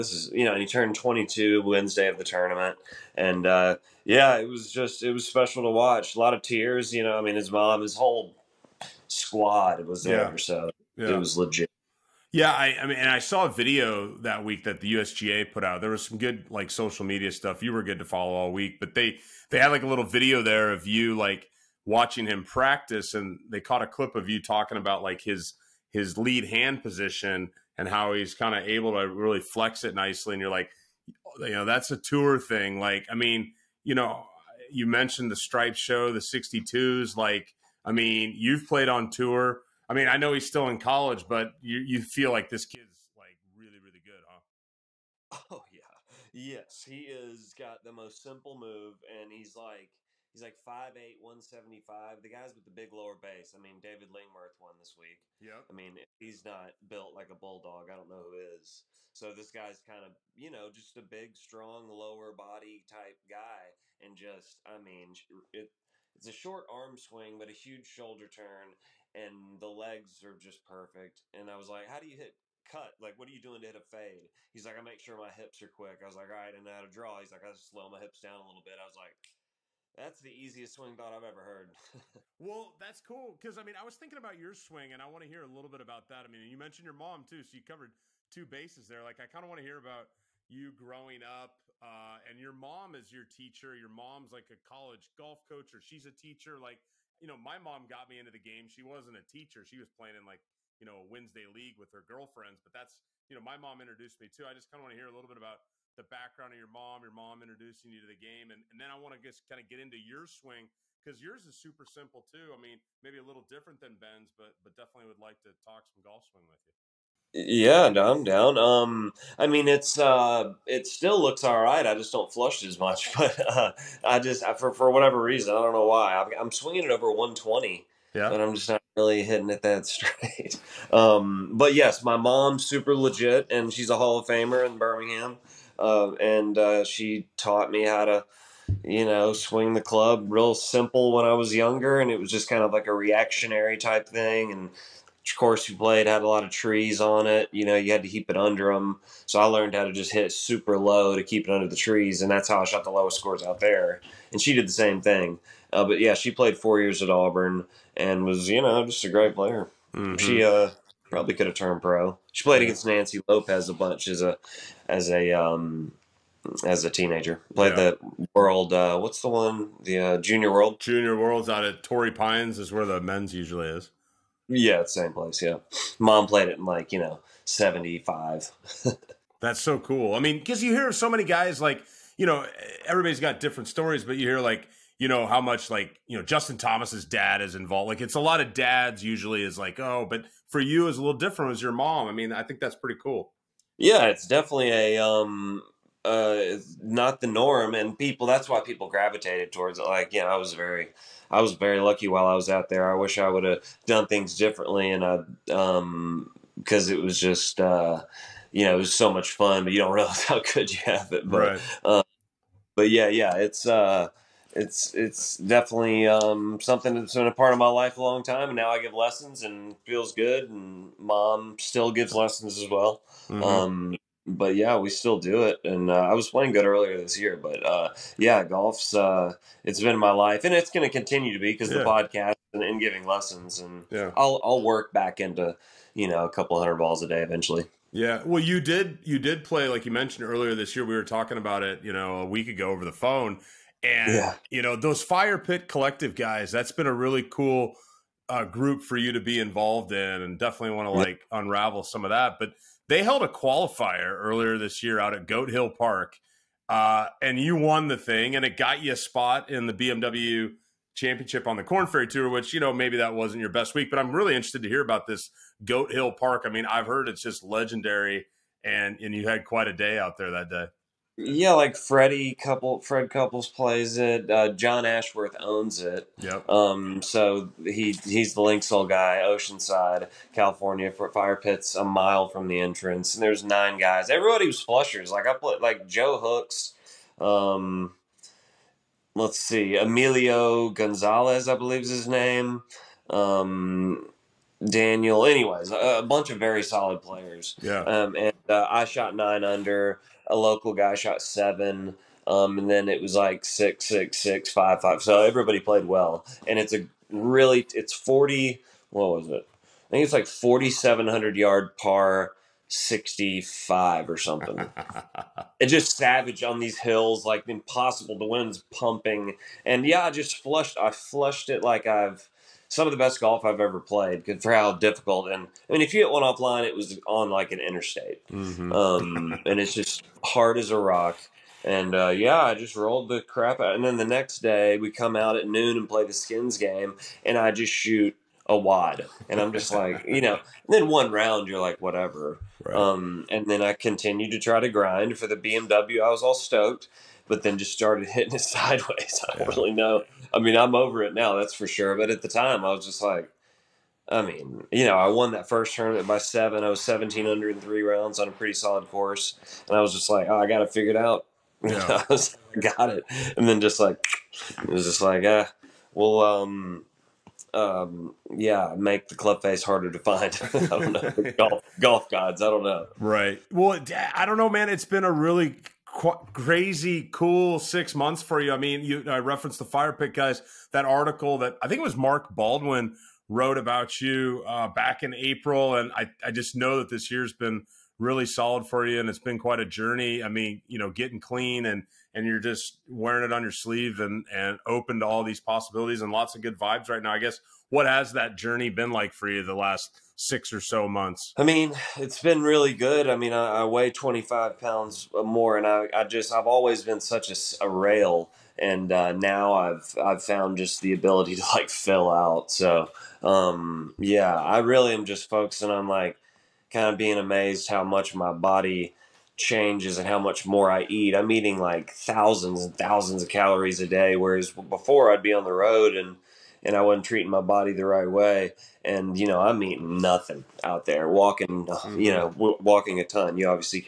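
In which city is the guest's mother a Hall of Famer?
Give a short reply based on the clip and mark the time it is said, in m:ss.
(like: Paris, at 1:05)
Birmingham, at 2:14.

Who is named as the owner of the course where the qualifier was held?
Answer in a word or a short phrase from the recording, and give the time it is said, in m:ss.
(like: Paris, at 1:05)
John Ashworth, at 4:34.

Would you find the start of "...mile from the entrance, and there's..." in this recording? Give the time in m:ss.
4:41.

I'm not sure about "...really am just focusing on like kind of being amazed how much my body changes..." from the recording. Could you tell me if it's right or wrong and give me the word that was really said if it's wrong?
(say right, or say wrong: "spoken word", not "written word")
right.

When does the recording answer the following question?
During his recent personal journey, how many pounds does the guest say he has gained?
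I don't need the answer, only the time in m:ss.
6:43.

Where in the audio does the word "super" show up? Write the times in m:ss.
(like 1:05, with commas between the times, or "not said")
1:51, 2:12, 2:30.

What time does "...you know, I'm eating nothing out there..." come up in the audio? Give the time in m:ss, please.
7:09.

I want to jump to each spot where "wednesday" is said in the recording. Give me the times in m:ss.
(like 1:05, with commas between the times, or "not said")
0:01, 1:41.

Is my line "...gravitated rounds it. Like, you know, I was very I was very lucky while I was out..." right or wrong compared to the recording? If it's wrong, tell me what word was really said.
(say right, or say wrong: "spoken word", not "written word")
wrong: "towards", not "rounds".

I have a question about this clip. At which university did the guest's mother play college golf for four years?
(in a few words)
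Auburn.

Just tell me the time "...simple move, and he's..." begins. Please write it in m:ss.
0:48.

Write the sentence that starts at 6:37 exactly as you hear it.
I guess what has that journey been like for you the last six or so months?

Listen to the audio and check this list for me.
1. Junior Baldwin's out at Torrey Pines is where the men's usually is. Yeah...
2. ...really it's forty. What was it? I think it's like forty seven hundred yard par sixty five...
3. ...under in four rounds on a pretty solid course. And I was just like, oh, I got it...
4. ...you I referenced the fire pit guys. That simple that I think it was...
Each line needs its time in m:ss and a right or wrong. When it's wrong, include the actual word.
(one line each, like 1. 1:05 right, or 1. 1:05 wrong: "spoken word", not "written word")
1. 2:50 wrong: "World", not "Baldwin"
2. 5:07 right
3. 5:57 wrong: "three", not "four"
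4. 6:18 wrong: "article", not "simple".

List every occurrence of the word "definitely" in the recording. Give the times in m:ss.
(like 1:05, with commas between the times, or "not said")
1:54, 3:14, 3:35, 4:10.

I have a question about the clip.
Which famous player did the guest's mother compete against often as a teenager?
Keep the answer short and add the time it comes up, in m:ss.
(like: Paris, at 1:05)
Nancy Lopez, at 2:42.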